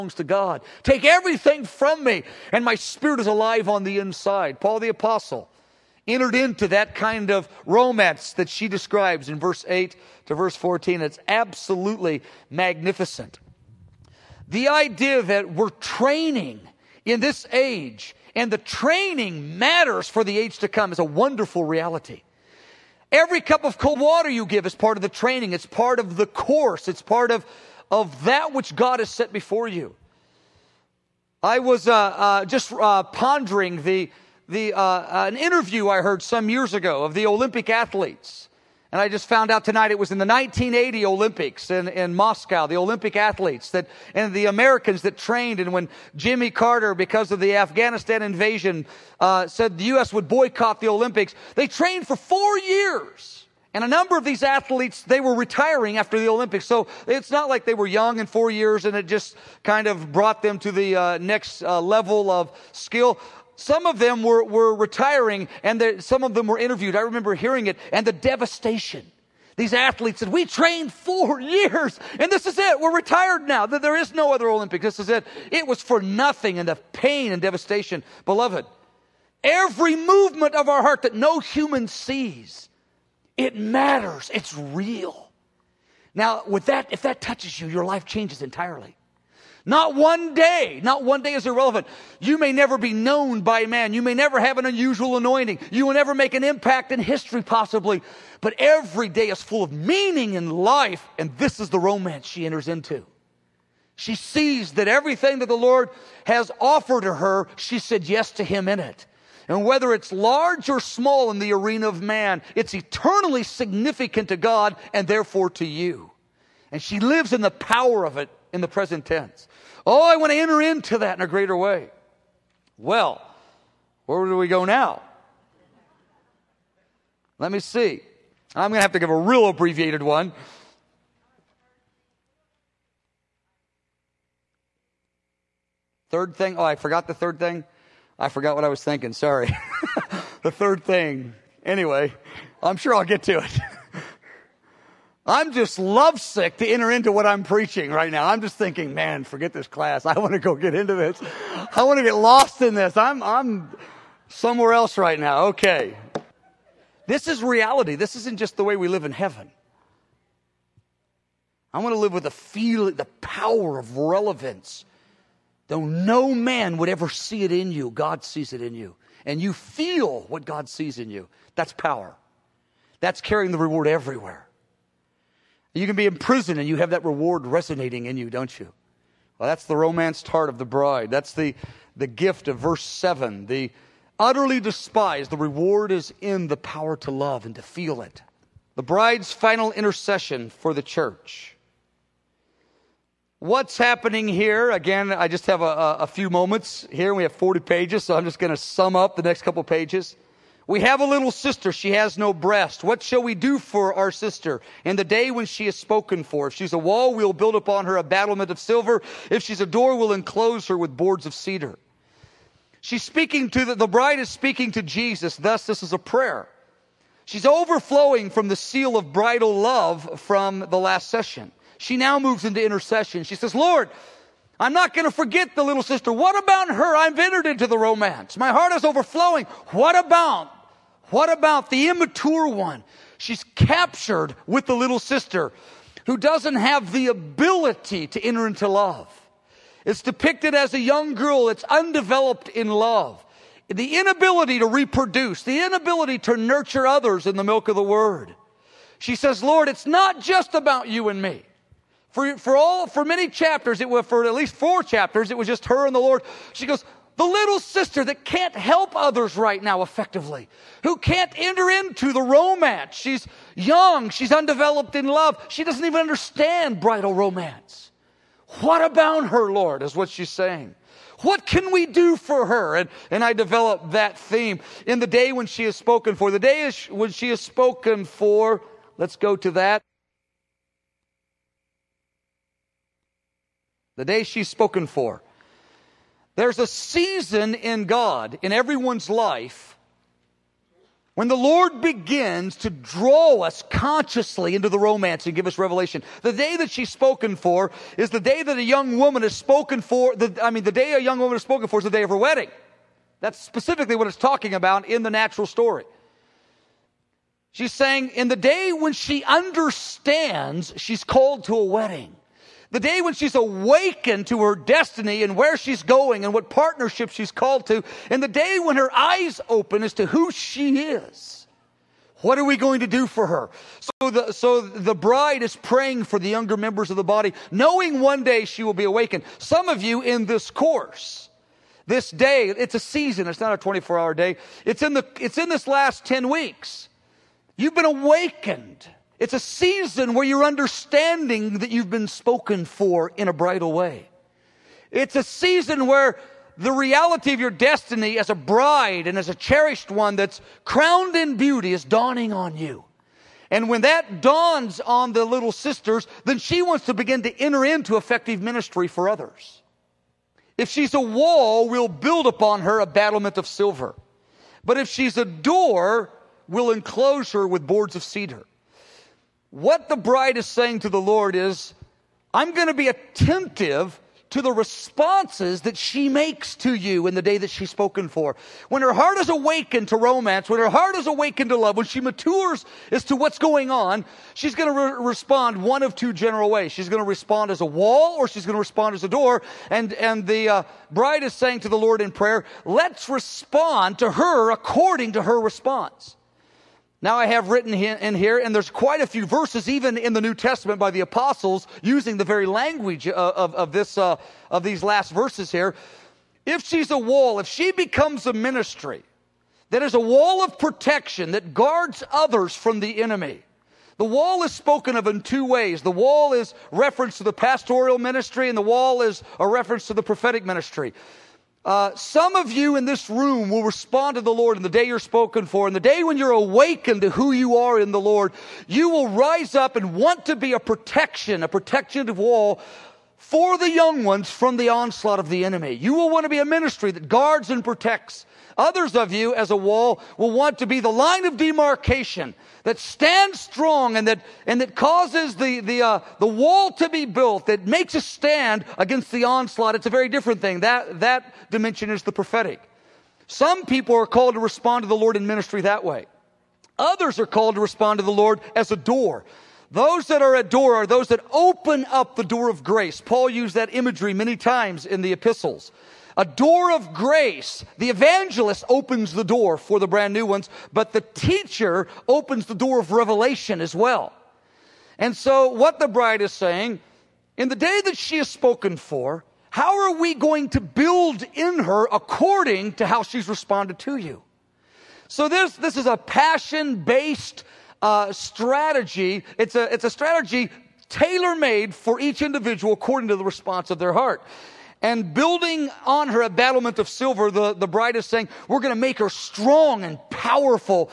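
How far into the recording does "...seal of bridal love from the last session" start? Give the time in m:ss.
3:38.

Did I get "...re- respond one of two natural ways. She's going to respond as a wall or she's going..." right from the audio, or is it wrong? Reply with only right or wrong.
wrong.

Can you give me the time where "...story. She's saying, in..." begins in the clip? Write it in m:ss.
5:05.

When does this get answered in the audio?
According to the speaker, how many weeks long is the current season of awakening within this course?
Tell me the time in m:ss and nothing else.
5:36.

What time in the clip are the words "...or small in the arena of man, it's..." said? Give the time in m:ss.
1:50.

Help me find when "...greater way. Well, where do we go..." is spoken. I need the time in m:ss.
2:01.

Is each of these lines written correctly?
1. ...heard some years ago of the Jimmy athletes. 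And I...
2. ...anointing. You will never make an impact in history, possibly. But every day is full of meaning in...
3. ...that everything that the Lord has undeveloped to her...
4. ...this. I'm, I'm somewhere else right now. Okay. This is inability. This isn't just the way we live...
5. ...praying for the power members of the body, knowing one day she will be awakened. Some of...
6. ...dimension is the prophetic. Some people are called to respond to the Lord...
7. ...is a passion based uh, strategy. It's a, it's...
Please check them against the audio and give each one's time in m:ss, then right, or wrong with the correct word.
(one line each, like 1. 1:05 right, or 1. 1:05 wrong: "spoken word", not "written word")
1. 0:36 wrong: "Olympic", not "Jimmy"
2. 1:35 right
3. 1:44 wrong: "offered", not "undeveloped"
4. 2:32 wrong: "reality", not "inability"
5. 5:25 wrong: "younger", not "power"
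6. 7:31 right
7. 8:05 right.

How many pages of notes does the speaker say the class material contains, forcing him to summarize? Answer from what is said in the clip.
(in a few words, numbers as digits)
40.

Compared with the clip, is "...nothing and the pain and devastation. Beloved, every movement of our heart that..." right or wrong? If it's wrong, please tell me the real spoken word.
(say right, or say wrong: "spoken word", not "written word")
right.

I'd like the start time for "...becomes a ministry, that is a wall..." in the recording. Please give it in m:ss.
6:47.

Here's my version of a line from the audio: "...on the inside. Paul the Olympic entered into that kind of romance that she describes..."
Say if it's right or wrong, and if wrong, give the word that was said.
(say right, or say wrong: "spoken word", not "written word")
wrong: "Apostle", not "Olympic".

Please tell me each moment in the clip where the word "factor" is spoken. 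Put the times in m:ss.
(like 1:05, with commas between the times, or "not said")
not said.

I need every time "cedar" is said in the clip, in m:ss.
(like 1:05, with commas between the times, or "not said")
3:31, 6:08.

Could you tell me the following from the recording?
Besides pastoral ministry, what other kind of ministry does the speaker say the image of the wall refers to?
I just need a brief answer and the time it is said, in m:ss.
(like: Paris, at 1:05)
Prophetic ministry, at 7:00.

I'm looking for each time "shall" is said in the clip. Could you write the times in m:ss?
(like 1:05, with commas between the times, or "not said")
3:23.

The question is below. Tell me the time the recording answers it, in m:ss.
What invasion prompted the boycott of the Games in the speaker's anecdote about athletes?
0:47.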